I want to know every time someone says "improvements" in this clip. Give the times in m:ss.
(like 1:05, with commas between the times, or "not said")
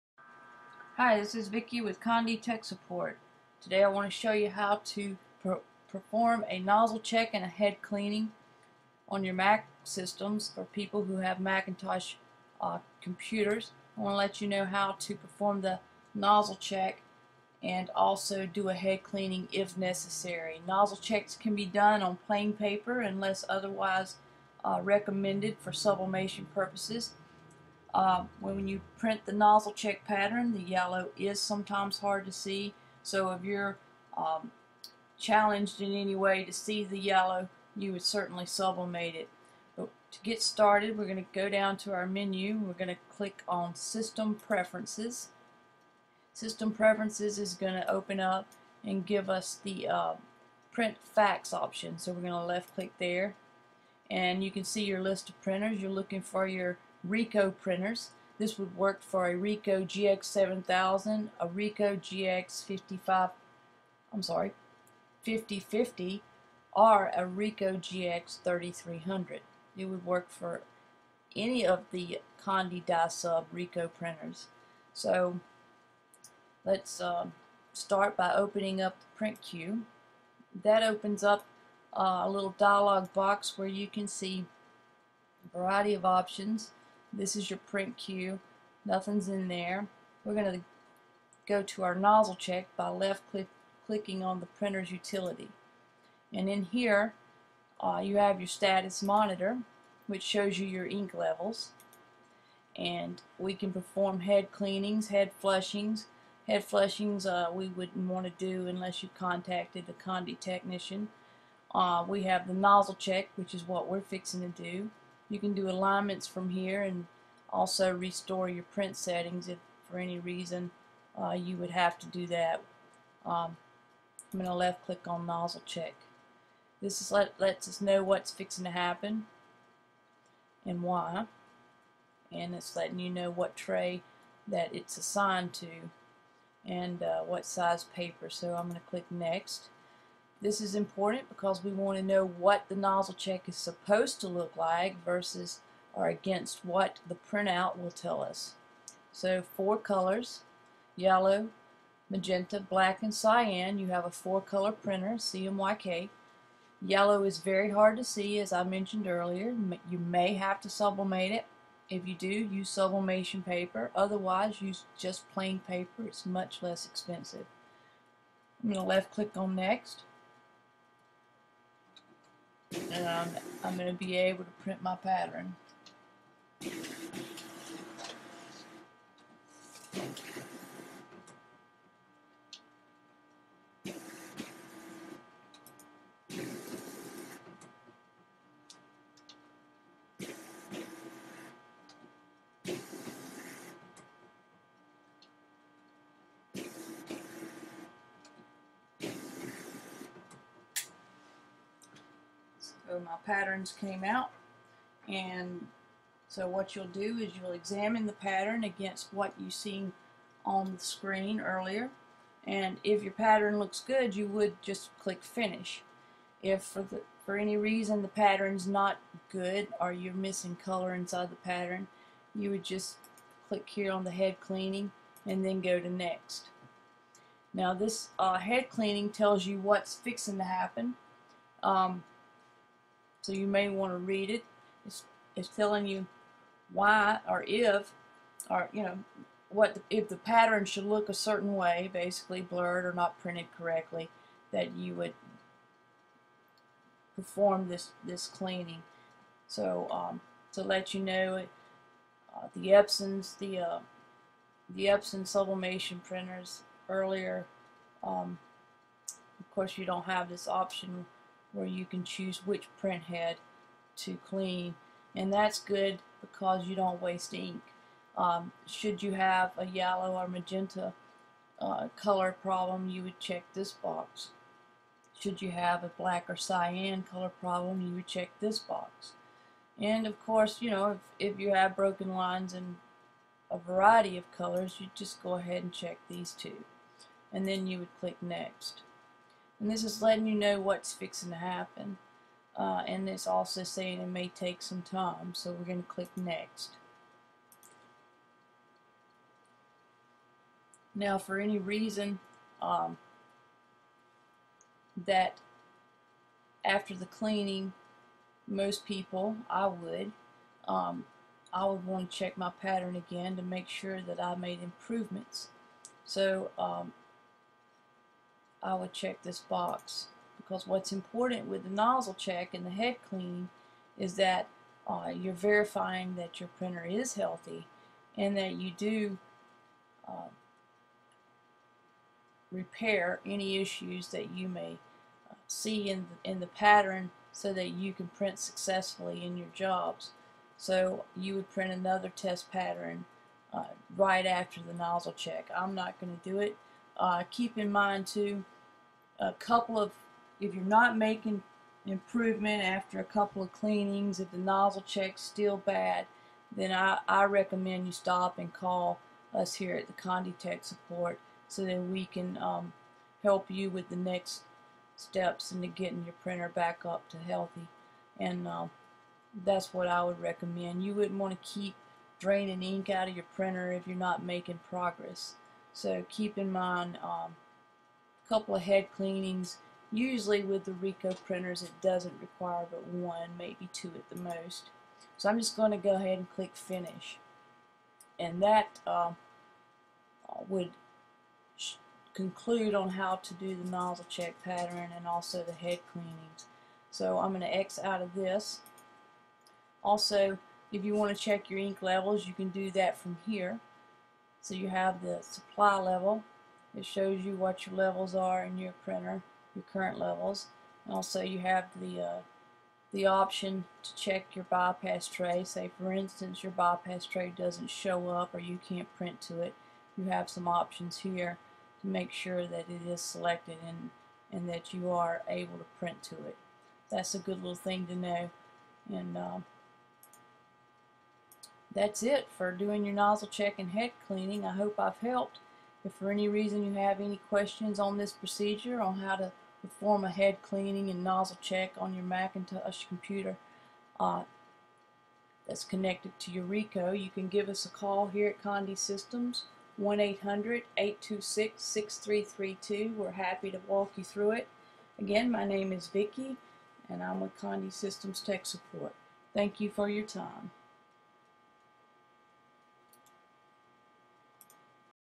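5:14, 5:51.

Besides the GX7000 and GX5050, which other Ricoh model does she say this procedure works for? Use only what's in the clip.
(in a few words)
Ricoh GX3300.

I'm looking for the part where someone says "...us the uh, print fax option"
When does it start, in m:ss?
0:49.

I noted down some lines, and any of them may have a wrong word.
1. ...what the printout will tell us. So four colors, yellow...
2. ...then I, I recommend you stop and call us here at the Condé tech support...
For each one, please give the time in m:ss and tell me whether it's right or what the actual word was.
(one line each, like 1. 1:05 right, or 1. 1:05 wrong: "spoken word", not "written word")
1. 2:26 right
2. 5:56 right.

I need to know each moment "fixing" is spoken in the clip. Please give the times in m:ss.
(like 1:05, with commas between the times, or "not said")
1:54, 2:08, 3:49, 4:50.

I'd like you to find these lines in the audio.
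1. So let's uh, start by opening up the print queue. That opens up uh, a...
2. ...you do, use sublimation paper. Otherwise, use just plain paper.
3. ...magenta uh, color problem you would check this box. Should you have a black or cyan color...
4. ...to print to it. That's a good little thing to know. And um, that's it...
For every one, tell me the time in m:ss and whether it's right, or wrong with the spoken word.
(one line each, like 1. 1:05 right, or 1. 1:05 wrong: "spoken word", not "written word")
1. 1:14 right
2. 2:42 right
3. 4:30 right
4. 7:05 right.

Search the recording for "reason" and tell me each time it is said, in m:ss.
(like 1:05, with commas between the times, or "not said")
2:00, 3:37, 5:01, 7:16.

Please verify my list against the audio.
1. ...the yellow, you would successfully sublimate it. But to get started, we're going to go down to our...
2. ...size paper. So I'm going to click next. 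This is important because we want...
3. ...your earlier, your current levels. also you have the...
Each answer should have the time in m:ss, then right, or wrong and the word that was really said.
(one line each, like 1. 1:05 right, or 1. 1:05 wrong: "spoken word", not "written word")
1. 0:36 wrong: "certainly", not "successfully"
2. 2:17 right
3. 6:48 wrong: "printer", not "earlier".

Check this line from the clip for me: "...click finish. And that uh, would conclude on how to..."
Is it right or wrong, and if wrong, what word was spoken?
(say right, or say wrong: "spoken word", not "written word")
right.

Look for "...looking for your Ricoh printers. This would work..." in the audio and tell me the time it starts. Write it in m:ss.
0:55.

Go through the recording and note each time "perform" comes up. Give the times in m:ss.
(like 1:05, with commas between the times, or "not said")
0:05, 0:15, 1:43, 4:07, 7:19.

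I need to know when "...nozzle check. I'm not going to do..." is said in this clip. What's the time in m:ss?
5:44.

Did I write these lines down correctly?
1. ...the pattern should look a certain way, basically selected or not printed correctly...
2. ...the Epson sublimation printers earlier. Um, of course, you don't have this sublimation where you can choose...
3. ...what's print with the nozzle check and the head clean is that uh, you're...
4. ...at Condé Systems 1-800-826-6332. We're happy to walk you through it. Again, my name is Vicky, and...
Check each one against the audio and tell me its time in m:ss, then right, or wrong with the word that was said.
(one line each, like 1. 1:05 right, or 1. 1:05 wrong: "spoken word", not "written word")
1. 4:00 wrong: "blurred", not "selected"
2. 4:14 wrong: "option", not "sublimation"
3. 5:20 wrong: "important", not "print"
4. 7:28 right.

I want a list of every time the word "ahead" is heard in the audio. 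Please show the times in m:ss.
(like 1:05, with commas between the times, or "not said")
4:45, 6:25.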